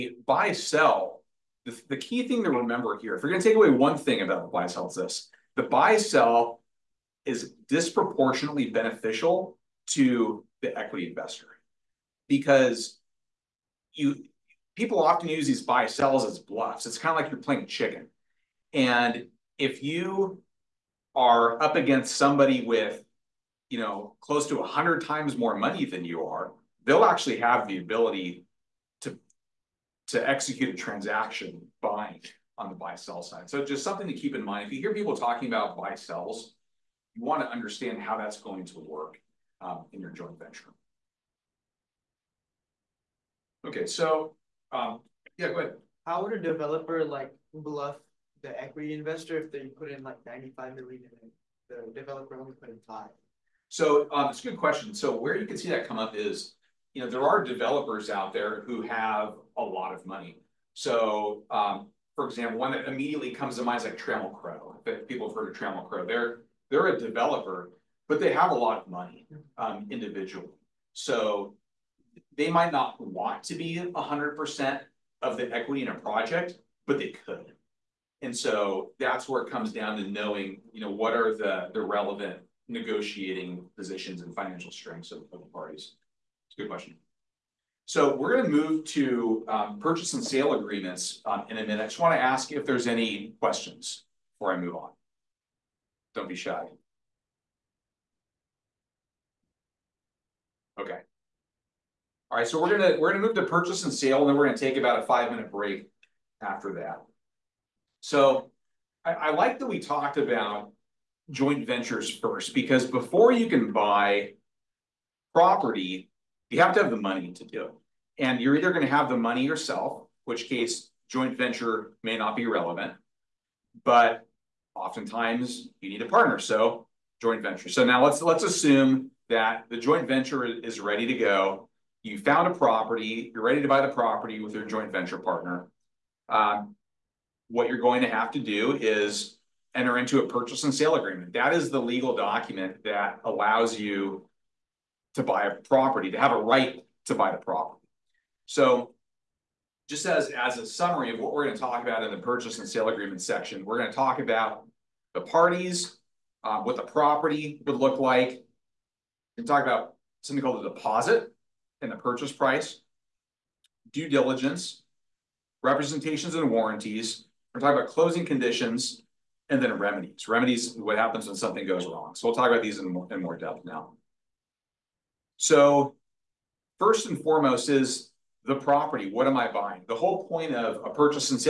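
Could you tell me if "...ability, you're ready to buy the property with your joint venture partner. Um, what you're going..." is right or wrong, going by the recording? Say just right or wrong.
wrong.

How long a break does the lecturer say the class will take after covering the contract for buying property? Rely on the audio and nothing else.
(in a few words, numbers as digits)
5 minutes.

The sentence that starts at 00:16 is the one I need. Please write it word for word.
It's kind of like you're playing chicken.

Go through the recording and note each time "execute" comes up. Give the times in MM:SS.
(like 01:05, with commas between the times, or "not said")
00:30.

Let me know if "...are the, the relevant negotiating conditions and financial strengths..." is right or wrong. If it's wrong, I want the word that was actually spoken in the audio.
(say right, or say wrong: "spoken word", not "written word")
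wrong: "positions", not "conditions".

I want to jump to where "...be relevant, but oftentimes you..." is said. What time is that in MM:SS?
02:02.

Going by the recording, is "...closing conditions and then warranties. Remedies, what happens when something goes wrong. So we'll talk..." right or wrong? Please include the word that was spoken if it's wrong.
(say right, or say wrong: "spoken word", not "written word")
wrong: "remedies", not "warranties".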